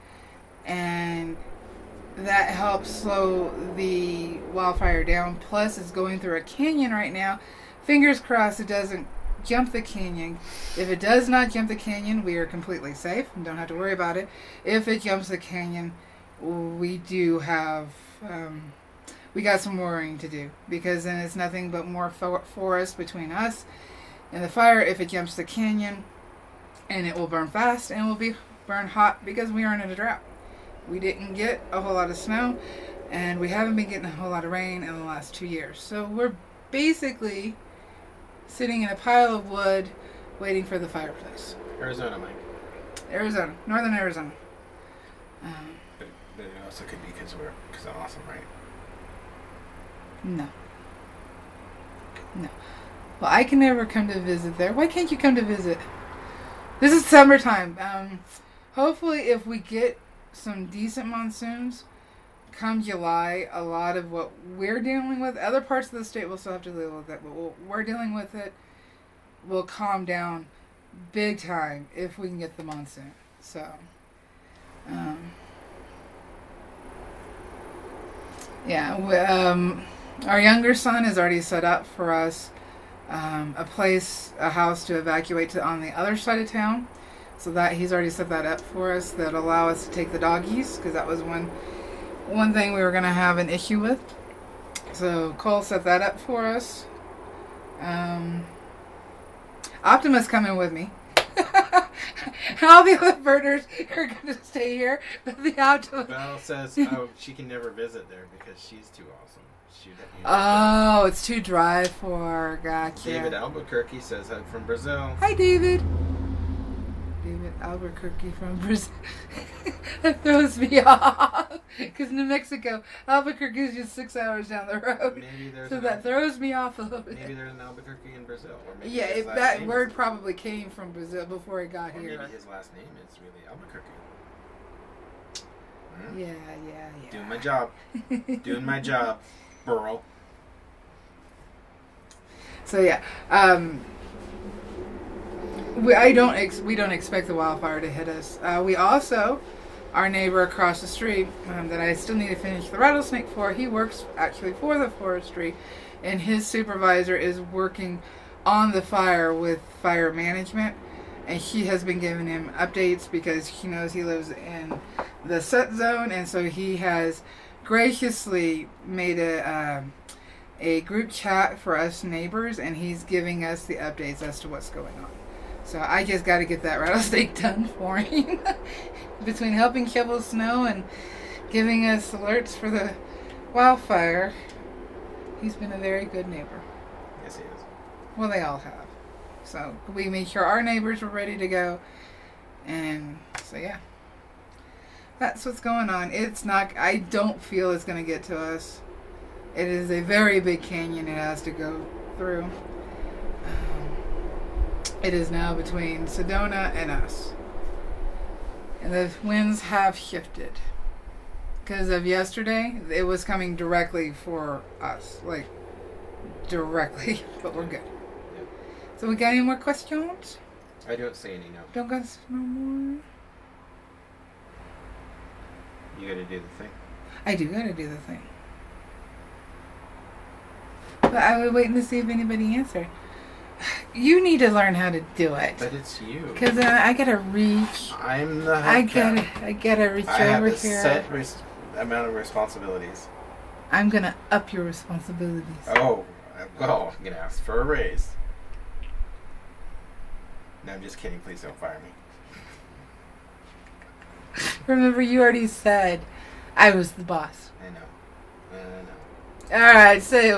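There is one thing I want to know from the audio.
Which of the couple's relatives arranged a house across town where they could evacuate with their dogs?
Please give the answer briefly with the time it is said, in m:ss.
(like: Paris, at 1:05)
Cole, at 1:35.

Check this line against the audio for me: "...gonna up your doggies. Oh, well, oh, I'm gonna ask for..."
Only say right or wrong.
wrong.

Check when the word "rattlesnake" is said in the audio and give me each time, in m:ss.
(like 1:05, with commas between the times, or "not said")
2:32, 2:56.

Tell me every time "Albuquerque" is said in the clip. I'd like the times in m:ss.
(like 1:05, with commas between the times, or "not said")
1:53, 1:57, 2:03, 2:07, 2:13.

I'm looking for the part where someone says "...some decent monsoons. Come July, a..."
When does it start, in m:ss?
1:00.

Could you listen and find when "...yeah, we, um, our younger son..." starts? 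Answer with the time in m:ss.
1:18.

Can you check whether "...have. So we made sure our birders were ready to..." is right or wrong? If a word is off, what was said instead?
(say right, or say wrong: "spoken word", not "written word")
wrong: "neighbors", not "birders".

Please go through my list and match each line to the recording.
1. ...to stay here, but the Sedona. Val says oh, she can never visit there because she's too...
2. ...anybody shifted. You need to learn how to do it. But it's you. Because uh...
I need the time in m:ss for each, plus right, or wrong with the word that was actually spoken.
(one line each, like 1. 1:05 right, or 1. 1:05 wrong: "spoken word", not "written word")
1. 1:44 wrong: "Optimus", not "Sedona"
2. 3:52 wrong: "answered", not "shifted".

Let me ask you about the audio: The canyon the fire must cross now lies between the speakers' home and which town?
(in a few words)
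Sedona.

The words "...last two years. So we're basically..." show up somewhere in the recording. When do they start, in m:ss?
0:35.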